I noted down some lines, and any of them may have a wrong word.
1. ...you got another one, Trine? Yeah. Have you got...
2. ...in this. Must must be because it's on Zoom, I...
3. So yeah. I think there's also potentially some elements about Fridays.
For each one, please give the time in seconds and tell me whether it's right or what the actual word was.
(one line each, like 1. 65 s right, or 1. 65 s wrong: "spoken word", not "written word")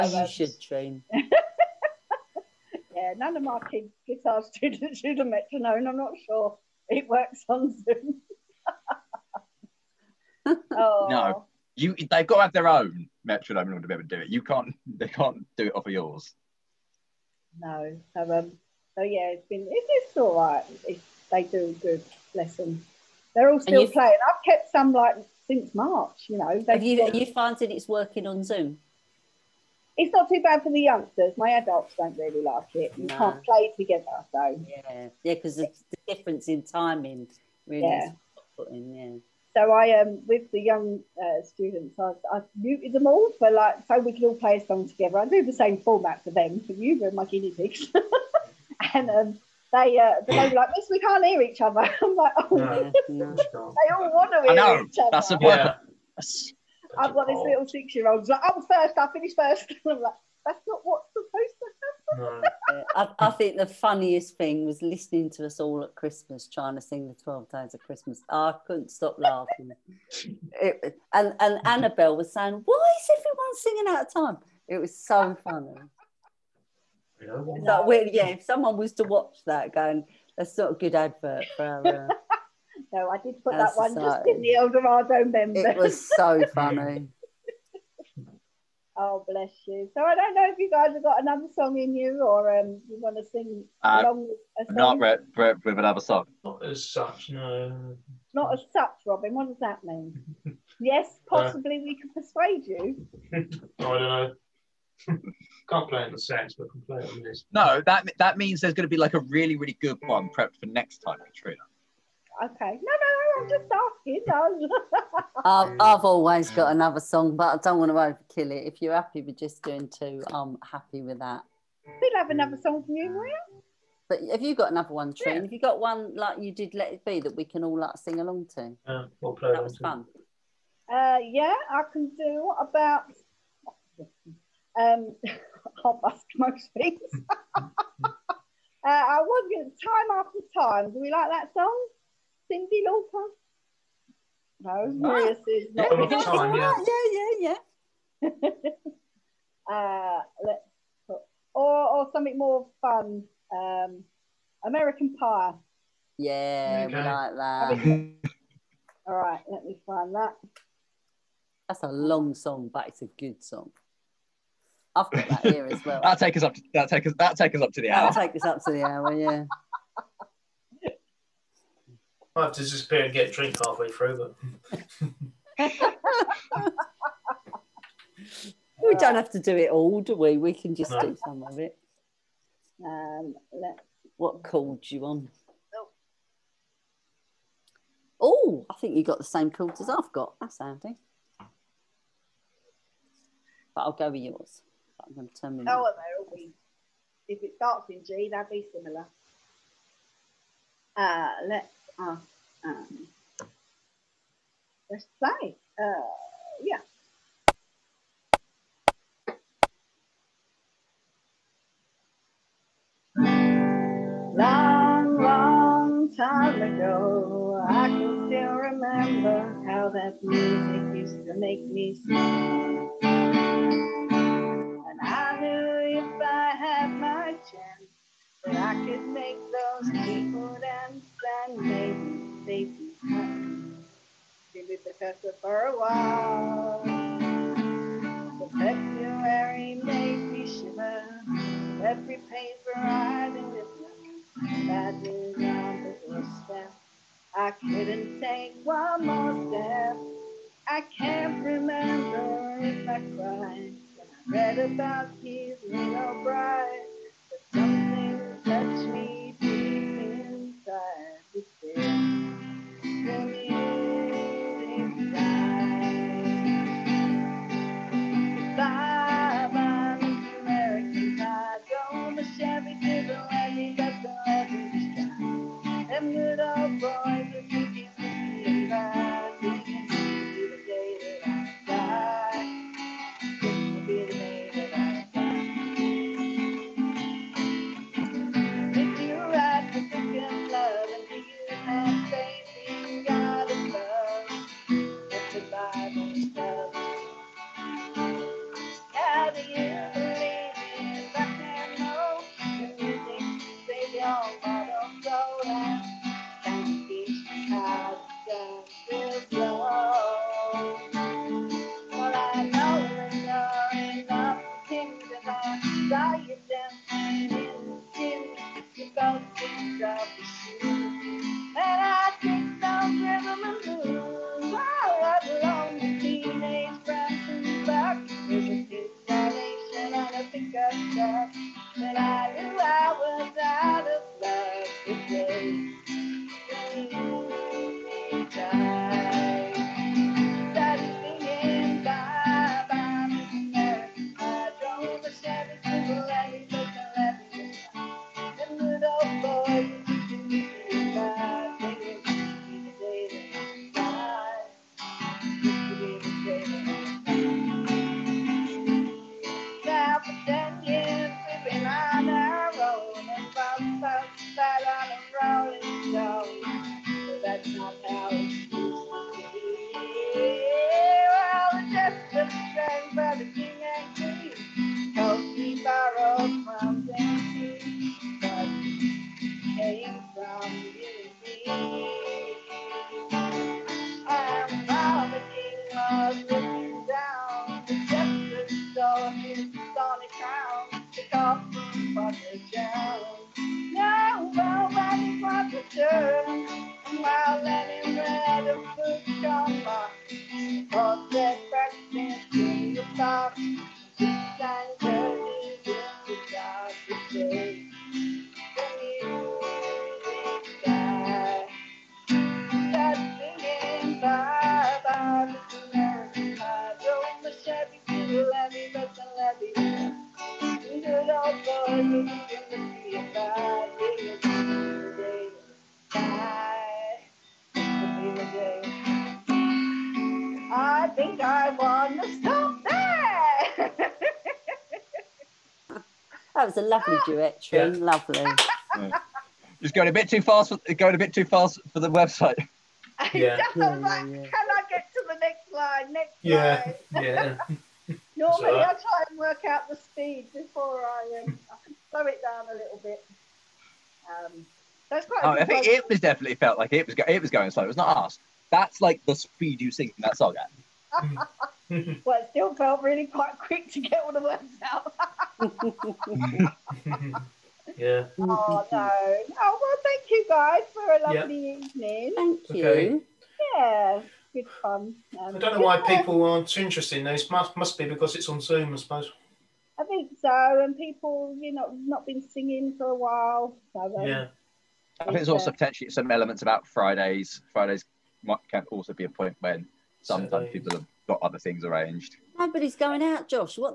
1. 124 s right
2. 476 s right
3. 483 s right.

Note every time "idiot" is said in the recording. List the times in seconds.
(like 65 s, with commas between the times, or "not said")
not said.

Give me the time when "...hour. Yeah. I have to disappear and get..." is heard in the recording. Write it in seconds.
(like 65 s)
168 s.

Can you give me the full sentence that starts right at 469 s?
Oh well, thank you guys for a lovely yep.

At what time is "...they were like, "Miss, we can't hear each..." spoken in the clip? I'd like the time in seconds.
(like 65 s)
50 s.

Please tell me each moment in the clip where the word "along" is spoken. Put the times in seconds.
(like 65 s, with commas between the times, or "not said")
94 s, 128 s.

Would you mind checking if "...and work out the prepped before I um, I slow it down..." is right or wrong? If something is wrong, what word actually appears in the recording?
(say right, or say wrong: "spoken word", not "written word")
wrong: "speed", not "prepped".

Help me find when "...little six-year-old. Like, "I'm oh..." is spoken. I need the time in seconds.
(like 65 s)
57 s.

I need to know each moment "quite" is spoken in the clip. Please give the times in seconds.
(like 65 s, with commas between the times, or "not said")
455 s, 463 s.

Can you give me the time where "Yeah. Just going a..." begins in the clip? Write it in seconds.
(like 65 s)
438 s.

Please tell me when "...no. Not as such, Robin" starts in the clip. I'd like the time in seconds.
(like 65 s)
97 s.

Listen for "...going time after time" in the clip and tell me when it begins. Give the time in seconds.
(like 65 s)
139 s.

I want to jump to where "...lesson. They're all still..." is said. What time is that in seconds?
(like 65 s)
22 s.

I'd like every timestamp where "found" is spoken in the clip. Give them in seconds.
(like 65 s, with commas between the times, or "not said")
27 s.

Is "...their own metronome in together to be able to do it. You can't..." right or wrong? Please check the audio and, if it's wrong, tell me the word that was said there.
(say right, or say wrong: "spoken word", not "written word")
wrong: "order", not "together".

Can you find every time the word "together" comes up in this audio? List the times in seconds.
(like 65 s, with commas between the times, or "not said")
33 s, 44 s.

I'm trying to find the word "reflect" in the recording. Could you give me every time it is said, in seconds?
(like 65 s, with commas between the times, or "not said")
not said.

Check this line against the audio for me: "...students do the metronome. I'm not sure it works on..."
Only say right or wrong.
right.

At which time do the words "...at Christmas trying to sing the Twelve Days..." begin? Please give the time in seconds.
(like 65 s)
65 s.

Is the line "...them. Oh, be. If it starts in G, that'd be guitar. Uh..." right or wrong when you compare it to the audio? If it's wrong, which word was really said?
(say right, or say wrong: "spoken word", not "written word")
wrong: "similar", not "guitar".